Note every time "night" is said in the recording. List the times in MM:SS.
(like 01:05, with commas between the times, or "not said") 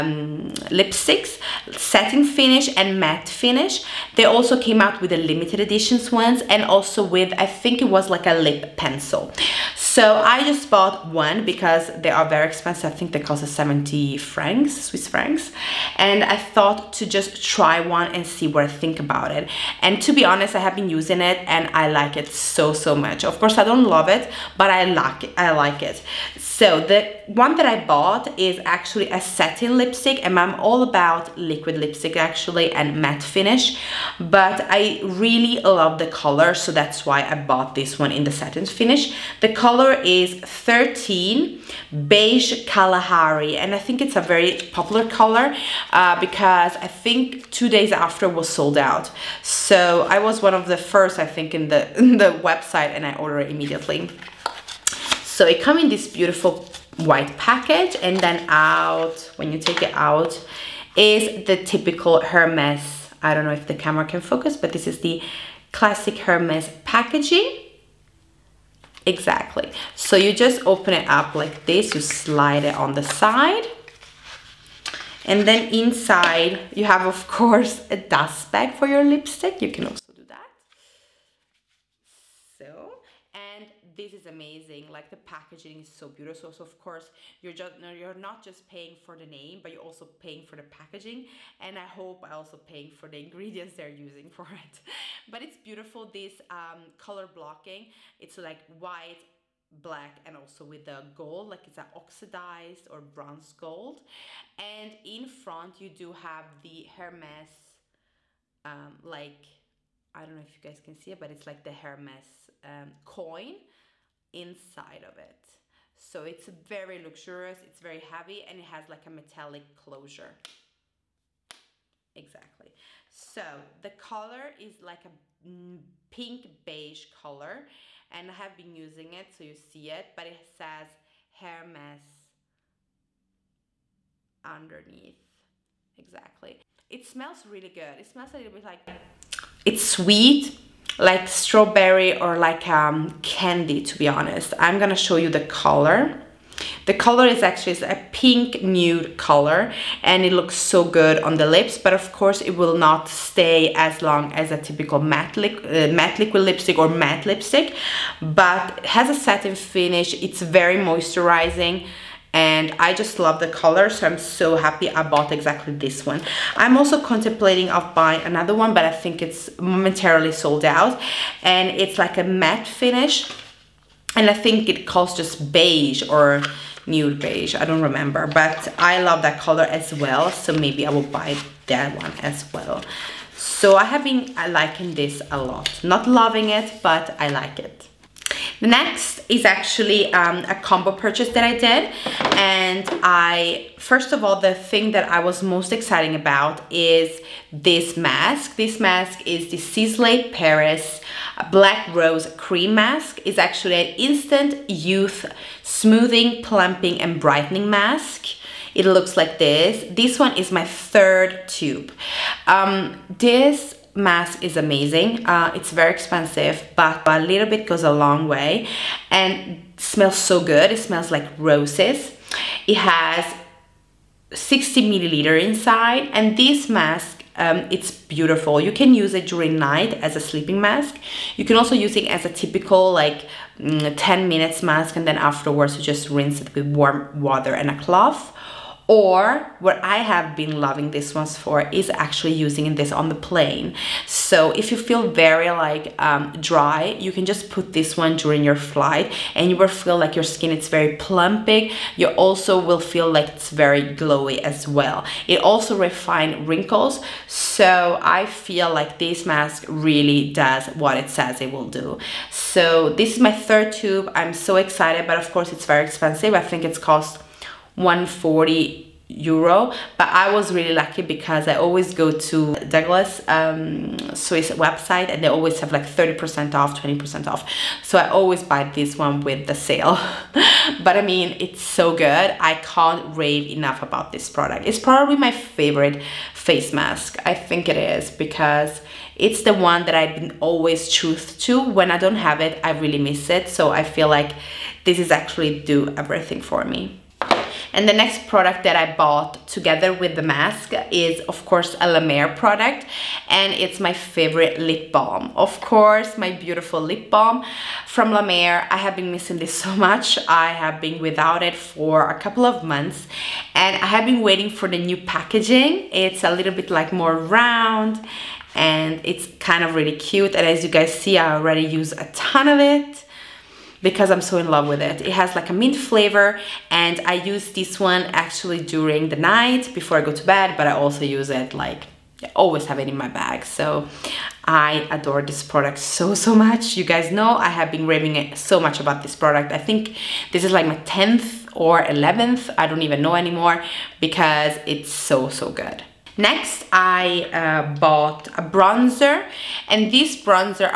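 03:49, 05:29.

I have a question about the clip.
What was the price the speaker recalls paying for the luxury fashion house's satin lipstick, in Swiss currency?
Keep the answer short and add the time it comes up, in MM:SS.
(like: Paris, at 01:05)
70 francs, at 00:13.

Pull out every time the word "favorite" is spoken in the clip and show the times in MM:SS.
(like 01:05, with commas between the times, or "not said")
04:45, 05:03.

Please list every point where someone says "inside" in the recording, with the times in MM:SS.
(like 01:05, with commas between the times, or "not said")
01:15, 01:54, 03:45.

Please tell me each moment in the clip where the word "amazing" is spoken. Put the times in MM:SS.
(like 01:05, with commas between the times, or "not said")
01:24, 03:34.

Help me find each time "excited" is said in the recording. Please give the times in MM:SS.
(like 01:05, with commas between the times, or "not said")
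03:15, 04:24.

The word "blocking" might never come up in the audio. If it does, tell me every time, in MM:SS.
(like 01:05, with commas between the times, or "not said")
01:37.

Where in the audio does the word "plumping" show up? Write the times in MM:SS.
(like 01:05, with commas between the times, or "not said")
03:26, 04:10.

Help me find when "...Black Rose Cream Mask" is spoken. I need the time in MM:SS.
03:21.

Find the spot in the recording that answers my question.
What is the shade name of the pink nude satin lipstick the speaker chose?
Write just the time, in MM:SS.
00:40.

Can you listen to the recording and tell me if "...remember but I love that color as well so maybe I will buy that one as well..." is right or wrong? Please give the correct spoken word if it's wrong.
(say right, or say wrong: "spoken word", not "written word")
right.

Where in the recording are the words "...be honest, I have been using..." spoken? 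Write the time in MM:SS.
00:20.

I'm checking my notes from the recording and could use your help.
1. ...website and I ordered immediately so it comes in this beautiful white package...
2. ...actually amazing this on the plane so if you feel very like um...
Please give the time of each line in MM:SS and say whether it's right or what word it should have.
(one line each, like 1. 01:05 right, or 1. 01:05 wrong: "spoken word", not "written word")
1. 00:52 right
2. 04:01 wrong: "using", not "amazing".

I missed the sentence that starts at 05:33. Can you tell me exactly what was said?
So I adore this product so, so much.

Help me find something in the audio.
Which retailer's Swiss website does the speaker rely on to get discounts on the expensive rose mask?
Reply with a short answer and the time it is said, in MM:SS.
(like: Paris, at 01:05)
Douglas, at 04:32.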